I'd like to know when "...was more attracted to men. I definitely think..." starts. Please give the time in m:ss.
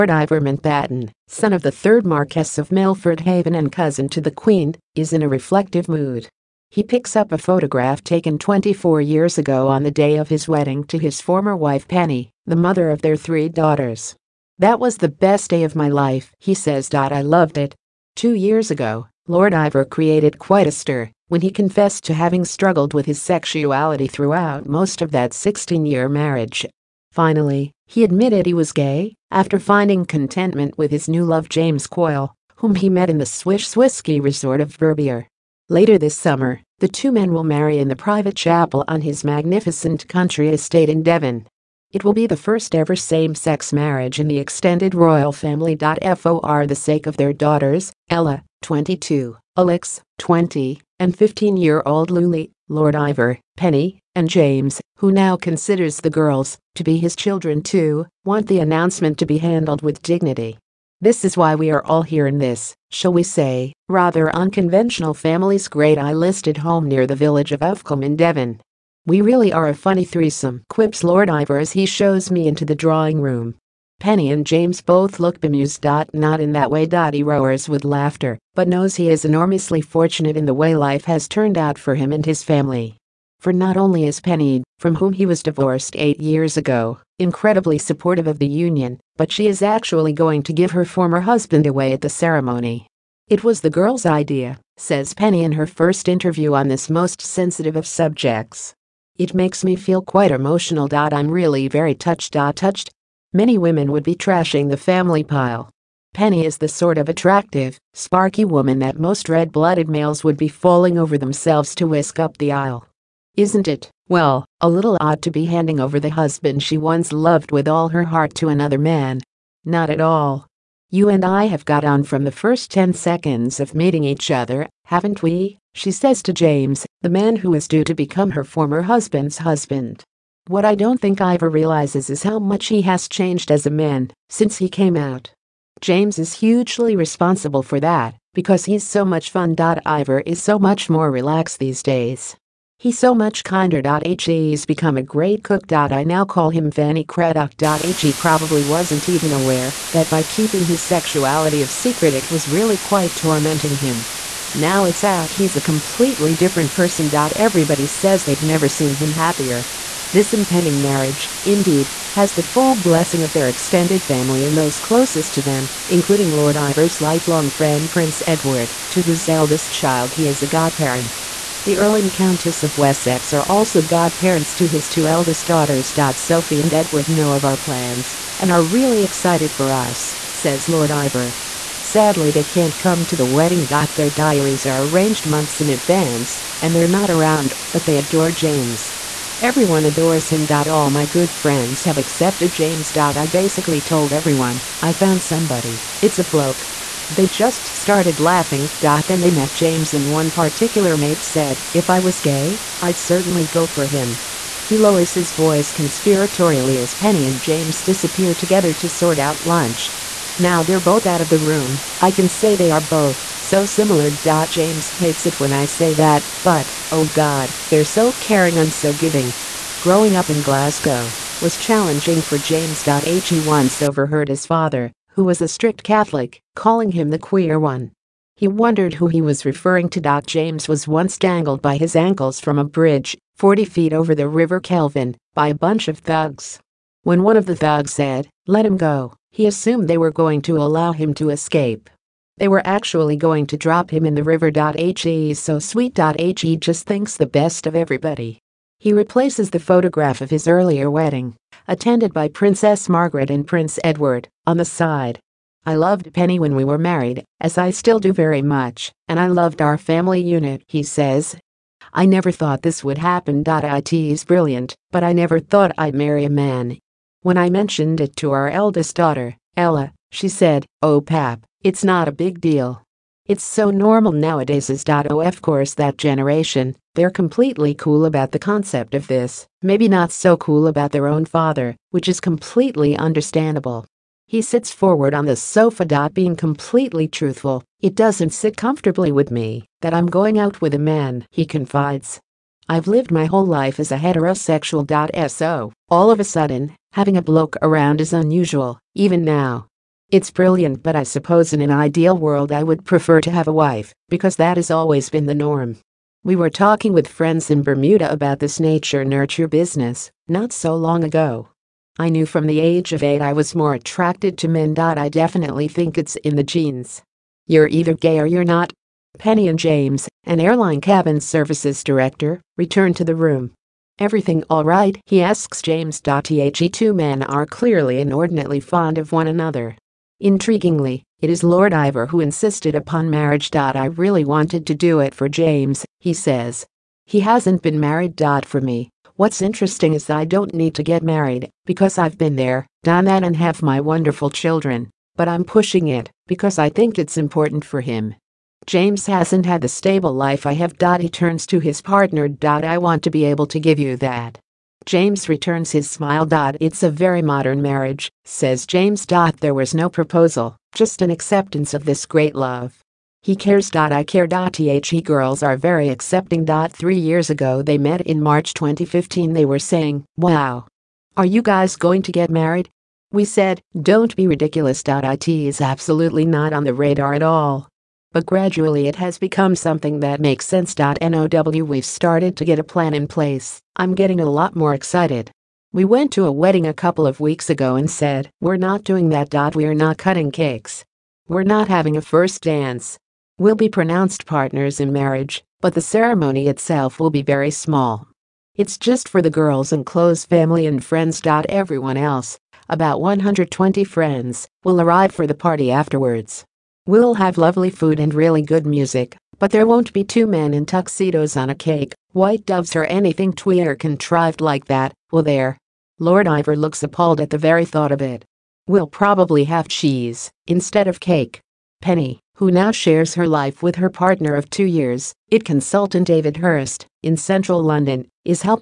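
5:13.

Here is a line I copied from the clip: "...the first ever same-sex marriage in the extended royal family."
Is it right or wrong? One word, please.
right.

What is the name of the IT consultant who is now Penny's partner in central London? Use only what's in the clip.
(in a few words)
David Hurst.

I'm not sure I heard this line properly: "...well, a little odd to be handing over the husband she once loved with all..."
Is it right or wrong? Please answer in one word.
right.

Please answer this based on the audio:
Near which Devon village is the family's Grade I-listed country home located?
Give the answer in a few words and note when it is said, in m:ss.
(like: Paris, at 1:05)
Uffculme, at 1:07.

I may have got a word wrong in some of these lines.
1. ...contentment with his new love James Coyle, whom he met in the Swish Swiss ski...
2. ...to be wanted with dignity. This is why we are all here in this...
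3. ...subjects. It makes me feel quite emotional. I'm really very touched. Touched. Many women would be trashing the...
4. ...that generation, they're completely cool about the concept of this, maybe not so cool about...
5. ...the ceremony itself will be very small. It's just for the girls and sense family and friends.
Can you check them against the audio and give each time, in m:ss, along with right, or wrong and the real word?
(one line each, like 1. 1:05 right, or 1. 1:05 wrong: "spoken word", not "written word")
1. 0:30 right
2. 0:59 wrong: "handled", not "wanted"
3. 1:37 right
4. 4:35 right
5. 6:35 wrong: "close", not "sense".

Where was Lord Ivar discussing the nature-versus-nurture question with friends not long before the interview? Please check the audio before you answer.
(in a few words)
Bermuda.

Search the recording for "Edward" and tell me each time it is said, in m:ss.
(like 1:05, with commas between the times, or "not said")
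2:48, 2:56, 4:13.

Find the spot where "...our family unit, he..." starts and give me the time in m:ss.
4:19.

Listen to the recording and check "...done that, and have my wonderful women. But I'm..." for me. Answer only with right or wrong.
wrong.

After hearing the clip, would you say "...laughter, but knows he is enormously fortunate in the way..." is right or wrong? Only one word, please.
right.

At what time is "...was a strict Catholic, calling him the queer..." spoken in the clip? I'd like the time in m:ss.
3:45.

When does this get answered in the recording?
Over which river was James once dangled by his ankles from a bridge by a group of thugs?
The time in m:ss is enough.
3:54.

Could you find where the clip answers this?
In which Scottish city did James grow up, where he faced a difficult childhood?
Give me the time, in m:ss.
3:40.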